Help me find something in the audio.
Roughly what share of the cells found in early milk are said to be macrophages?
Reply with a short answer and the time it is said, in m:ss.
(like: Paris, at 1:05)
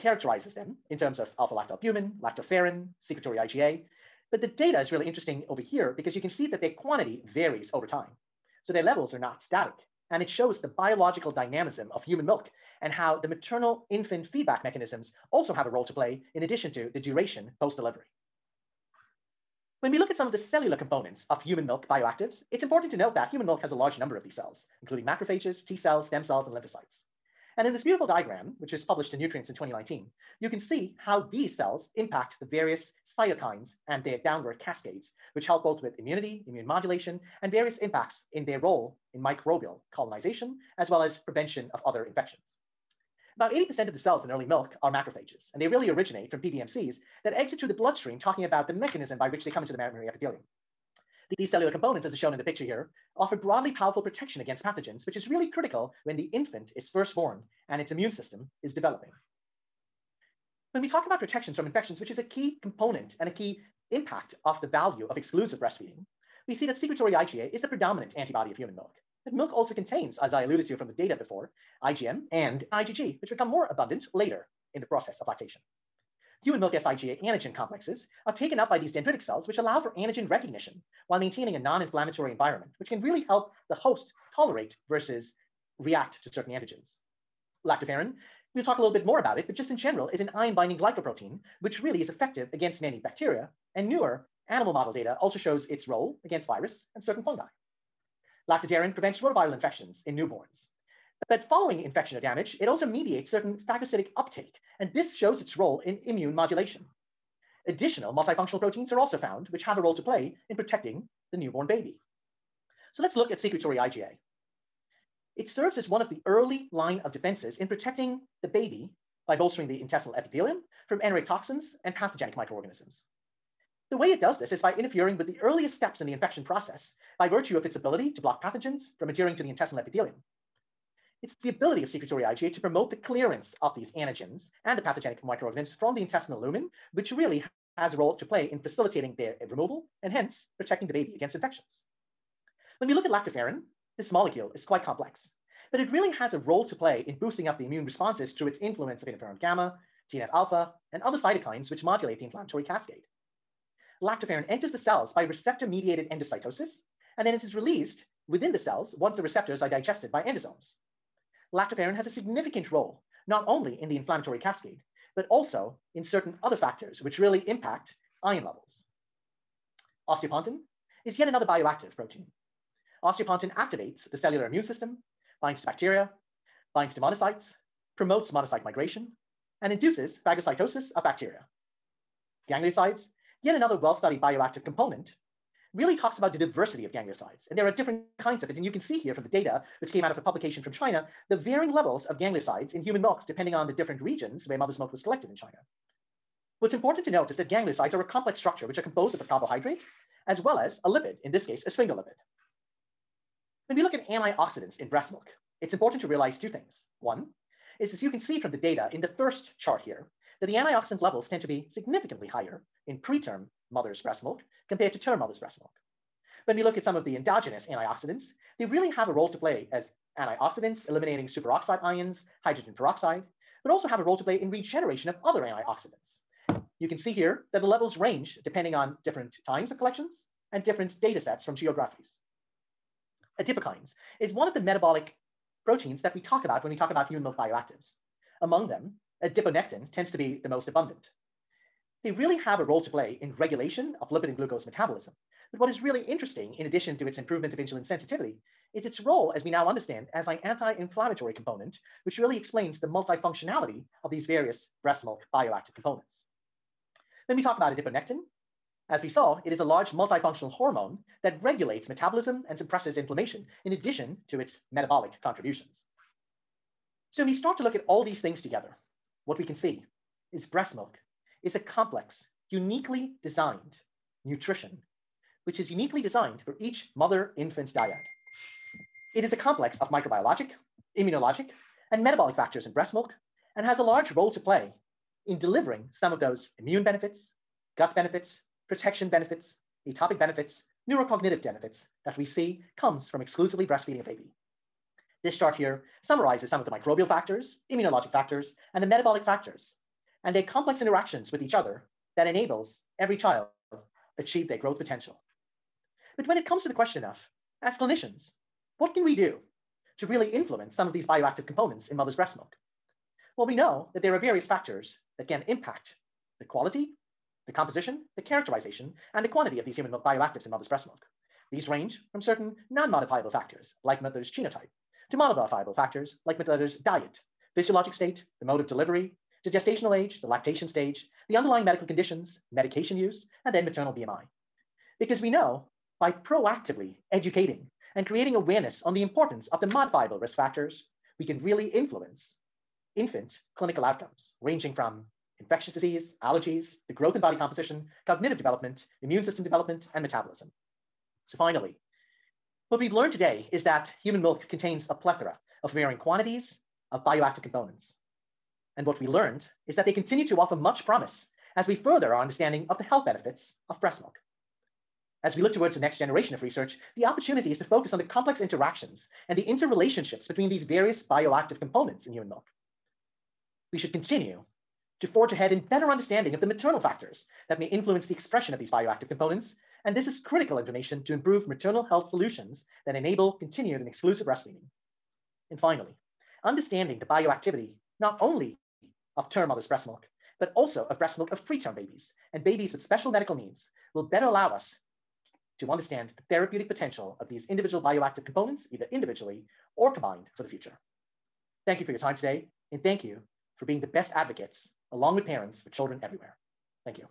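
80%, at 0:43.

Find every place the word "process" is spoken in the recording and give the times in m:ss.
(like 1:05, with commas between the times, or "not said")
1:14, 2:06.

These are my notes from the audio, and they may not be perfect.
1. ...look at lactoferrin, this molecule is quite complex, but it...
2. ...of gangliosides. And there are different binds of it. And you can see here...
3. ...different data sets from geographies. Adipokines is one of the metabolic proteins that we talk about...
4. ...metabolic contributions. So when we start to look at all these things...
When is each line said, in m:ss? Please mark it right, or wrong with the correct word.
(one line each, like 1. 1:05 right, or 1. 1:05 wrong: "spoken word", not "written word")
1. 2:22 right
2. 3:06 wrong: "kinds", not "binds"
3. 3:50 right
4. 4:24 right.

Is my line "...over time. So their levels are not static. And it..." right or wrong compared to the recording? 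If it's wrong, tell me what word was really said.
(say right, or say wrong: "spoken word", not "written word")
right.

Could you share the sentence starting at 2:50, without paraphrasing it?
Osteopontin is yet another bioactive protein.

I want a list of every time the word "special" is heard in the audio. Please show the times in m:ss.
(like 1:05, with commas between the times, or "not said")
6:32.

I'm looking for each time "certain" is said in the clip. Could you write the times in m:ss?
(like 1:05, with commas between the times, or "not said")
1:26, 1:37, 1:43, 2:46, 5:22.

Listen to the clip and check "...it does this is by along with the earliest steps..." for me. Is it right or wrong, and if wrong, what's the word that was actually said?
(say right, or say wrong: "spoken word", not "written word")
wrong: "interfering", not "along".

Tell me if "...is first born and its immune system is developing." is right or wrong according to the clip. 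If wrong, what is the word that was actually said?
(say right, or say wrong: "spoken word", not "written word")
right.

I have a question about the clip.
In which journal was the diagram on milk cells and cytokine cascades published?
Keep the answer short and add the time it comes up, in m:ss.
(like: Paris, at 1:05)
Nutrients, at 0:29.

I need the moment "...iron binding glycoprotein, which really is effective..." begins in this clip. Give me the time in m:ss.
1:30.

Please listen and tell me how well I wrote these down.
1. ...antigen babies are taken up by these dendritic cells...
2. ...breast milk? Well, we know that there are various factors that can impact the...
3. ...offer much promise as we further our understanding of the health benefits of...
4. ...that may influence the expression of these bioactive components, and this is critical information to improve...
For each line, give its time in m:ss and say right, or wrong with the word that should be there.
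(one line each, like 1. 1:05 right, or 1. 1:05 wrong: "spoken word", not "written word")
1. 1:17 wrong: "complexes", not "babies"
2. 5:12 right
3. 6:00 right
4. 6:17 right.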